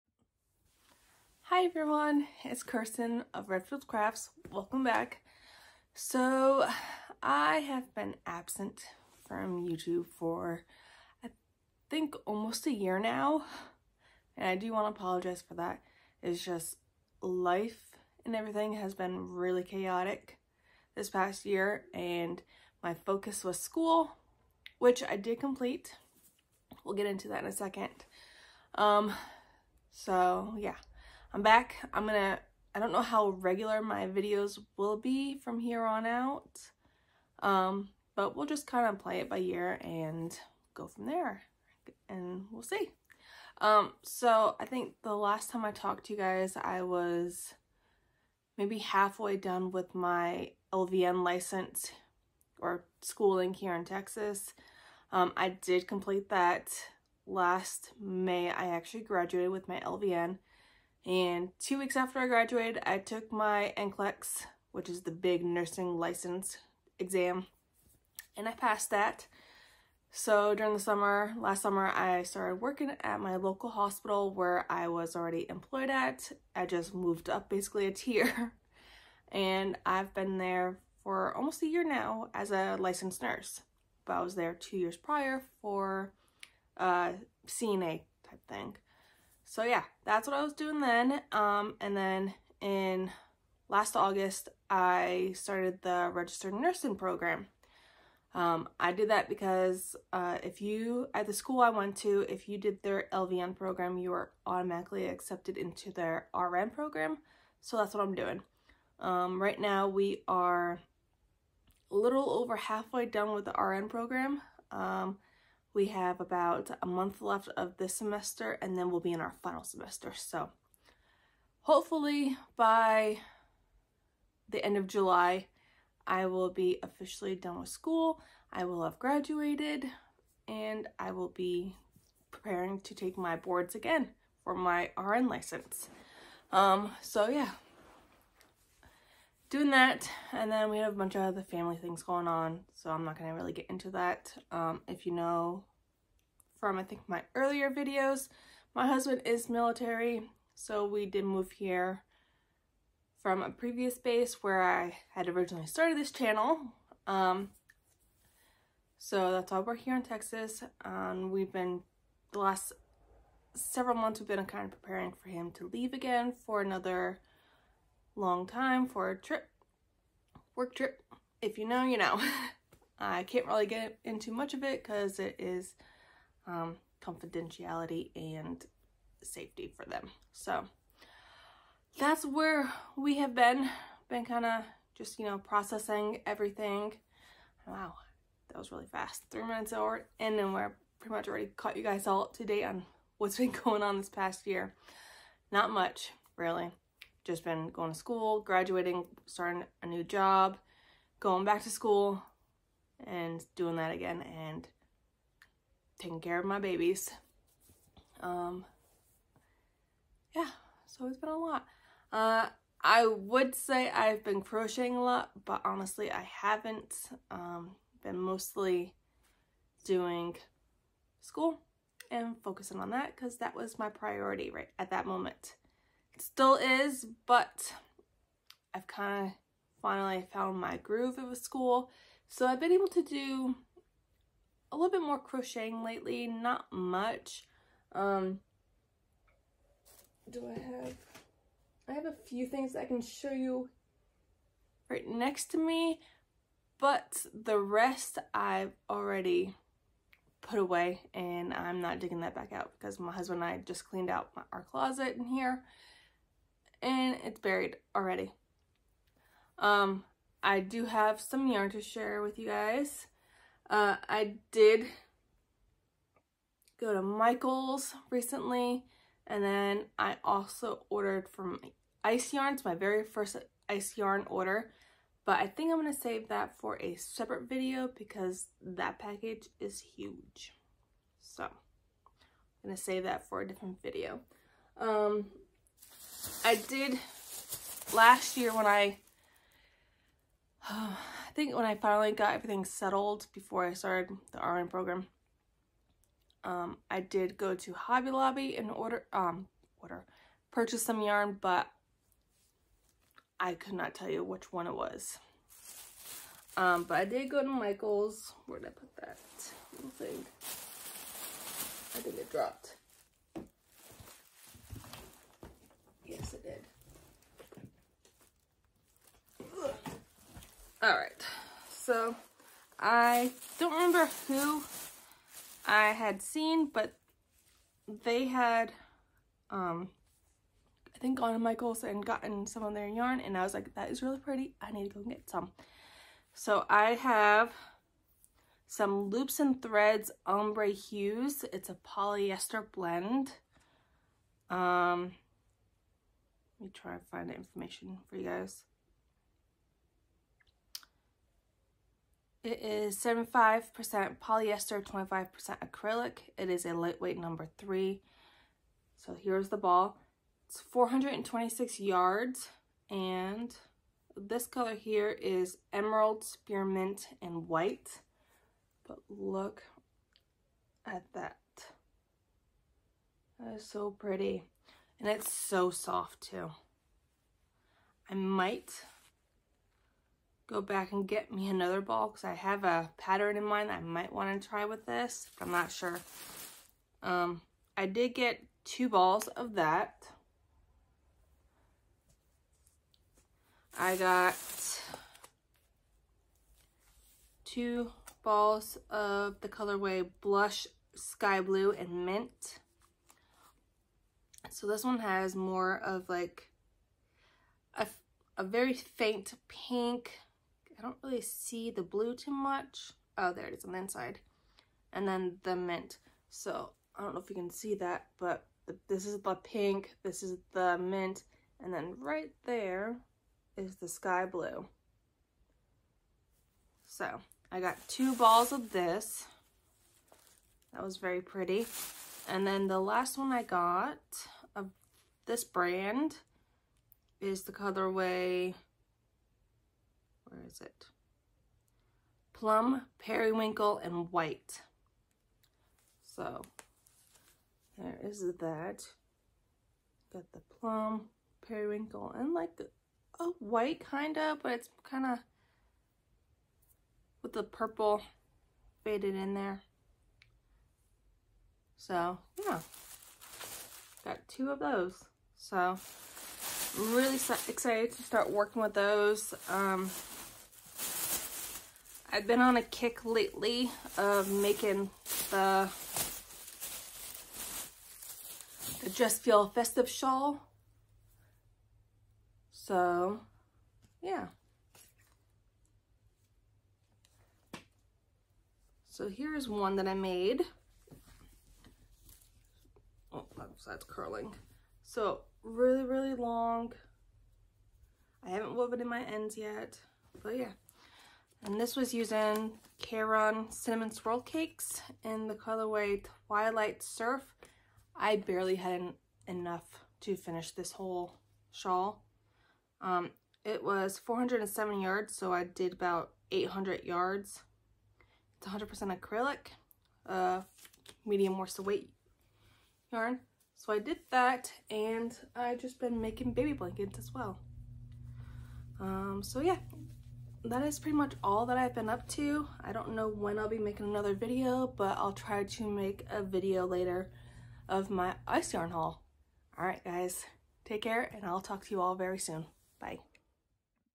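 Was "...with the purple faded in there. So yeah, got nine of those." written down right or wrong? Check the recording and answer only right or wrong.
wrong.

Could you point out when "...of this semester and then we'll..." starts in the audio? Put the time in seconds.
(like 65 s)
117 s.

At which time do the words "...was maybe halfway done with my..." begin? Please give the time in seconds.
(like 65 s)
46 s.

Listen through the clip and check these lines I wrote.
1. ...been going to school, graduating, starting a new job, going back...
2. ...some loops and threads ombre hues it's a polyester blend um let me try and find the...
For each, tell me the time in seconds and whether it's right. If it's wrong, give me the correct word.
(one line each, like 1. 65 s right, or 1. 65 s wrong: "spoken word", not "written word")
1. 197 s right
2. 338 s right.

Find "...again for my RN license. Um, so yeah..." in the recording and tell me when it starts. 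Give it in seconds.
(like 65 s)
133 s.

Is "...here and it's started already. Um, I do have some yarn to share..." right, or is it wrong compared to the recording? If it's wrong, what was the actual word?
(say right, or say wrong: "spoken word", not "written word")
wrong: "buried", not "started".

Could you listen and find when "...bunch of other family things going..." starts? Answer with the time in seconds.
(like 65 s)
140 s.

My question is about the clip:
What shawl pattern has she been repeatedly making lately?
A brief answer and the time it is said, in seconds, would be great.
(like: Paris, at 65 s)
Just Feel Festive shawl, at 478 s.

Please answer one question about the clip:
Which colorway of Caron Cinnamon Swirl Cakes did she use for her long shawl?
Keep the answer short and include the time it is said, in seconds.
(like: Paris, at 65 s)
Twilight Surf, at 506 s.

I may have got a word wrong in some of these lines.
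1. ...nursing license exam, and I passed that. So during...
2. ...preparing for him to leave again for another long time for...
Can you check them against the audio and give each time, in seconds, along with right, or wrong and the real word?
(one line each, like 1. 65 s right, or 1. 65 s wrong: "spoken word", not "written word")
1. 65 s right
2. 164 s right.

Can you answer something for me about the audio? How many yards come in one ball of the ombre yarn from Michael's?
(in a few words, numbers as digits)
426 yards.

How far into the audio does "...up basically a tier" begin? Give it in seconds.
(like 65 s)
77 s.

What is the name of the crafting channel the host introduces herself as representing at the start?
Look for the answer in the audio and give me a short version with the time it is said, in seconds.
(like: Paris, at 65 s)
Redfield Crafts, at 3 s.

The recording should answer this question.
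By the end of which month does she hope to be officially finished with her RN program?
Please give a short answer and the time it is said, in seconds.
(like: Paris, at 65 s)
July, at 124 s.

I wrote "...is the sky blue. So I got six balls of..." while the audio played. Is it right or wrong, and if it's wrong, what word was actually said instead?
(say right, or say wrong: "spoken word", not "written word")
wrong: "two", not "six".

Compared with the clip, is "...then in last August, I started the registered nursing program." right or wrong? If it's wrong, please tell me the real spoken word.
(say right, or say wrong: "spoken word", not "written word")
right.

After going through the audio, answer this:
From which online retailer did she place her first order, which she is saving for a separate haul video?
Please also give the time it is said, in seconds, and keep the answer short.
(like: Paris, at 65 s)
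Ice Yarns, at 272 s.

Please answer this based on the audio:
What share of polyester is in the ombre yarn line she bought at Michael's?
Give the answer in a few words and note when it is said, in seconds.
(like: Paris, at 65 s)
75% polyester, at 352 s.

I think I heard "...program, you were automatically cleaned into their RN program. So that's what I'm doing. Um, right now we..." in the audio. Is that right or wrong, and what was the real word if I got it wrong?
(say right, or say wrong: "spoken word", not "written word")
wrong: "accepted", not "cleaned".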